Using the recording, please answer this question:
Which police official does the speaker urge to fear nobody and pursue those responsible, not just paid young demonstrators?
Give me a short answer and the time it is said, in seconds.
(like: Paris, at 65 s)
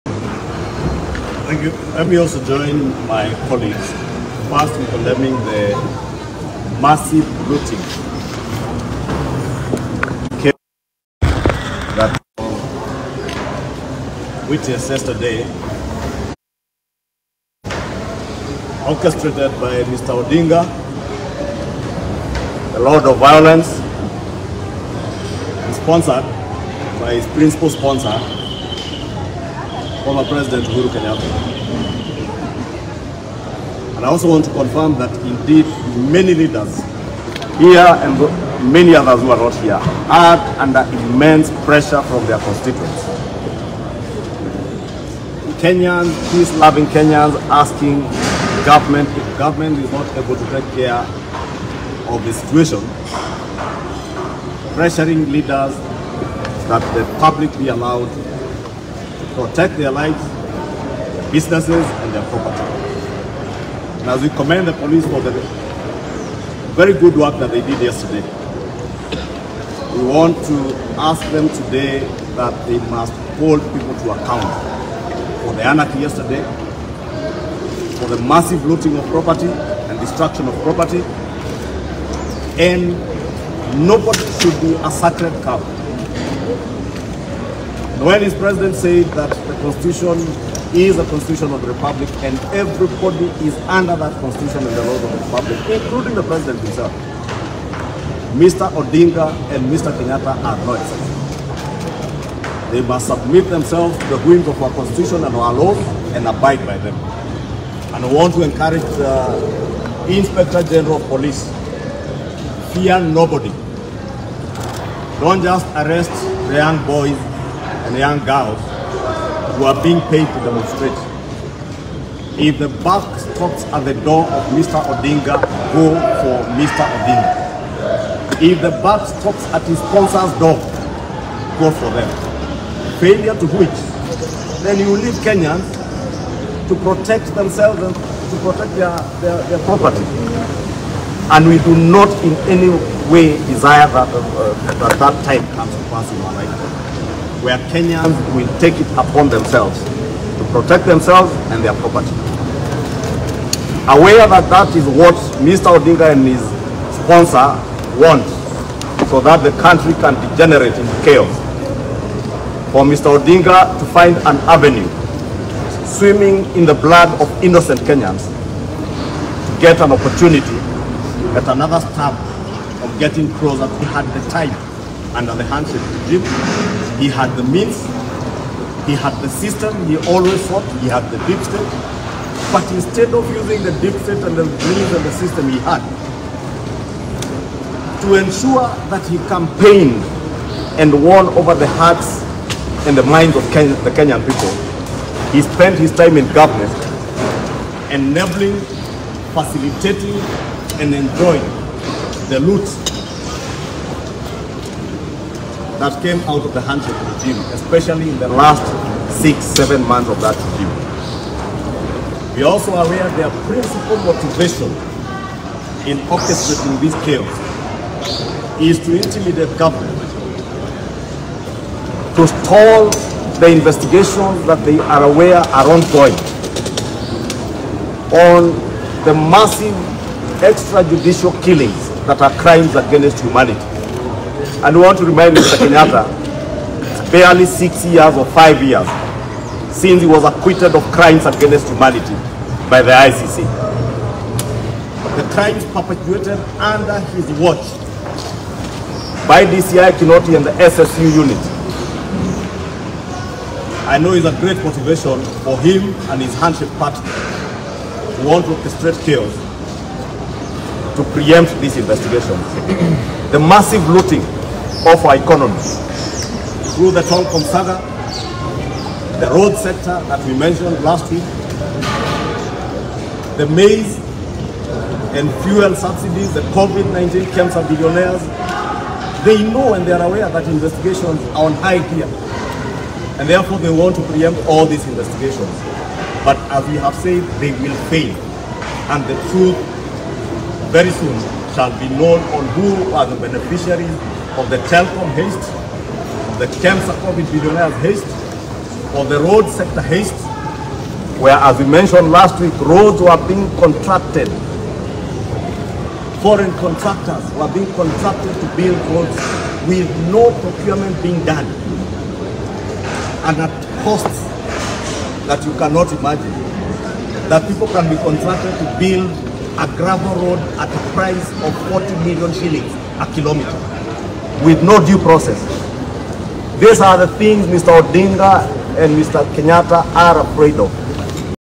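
Inspector General of Police, at 110 s.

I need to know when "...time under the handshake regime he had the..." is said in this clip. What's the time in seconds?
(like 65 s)
174 s.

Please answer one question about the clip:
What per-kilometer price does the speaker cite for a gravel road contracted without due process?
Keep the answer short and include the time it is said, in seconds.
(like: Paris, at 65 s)
40 million shillings, at 321 s.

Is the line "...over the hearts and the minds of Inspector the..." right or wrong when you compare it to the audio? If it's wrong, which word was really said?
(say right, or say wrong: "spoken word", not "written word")
wrong: "Ken", not "Inspector".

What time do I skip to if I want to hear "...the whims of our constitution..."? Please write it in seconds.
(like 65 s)
104 s.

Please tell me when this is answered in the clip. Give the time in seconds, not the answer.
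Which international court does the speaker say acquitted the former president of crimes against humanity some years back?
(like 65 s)
242 s.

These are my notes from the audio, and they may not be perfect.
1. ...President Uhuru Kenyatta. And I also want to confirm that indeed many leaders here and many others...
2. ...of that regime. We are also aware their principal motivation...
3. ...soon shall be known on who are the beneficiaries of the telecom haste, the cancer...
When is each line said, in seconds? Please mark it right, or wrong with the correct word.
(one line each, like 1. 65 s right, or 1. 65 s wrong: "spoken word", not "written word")
1. 30 s right
2. 210 s right
3. 290 s right.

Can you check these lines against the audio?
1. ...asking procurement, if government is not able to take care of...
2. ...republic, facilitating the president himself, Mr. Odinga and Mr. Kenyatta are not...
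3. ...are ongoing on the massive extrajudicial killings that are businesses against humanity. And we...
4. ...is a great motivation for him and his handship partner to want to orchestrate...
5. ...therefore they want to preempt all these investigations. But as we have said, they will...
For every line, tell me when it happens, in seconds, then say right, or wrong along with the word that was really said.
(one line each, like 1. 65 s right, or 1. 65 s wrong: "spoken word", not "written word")
1. 47 s wrong: "government", not "procurement"
2. 95 s wrong: "including", not "facilitating"
3. 225 s wrong: "crimes", not "businesses"
4. 254 s right
5. 283 s right.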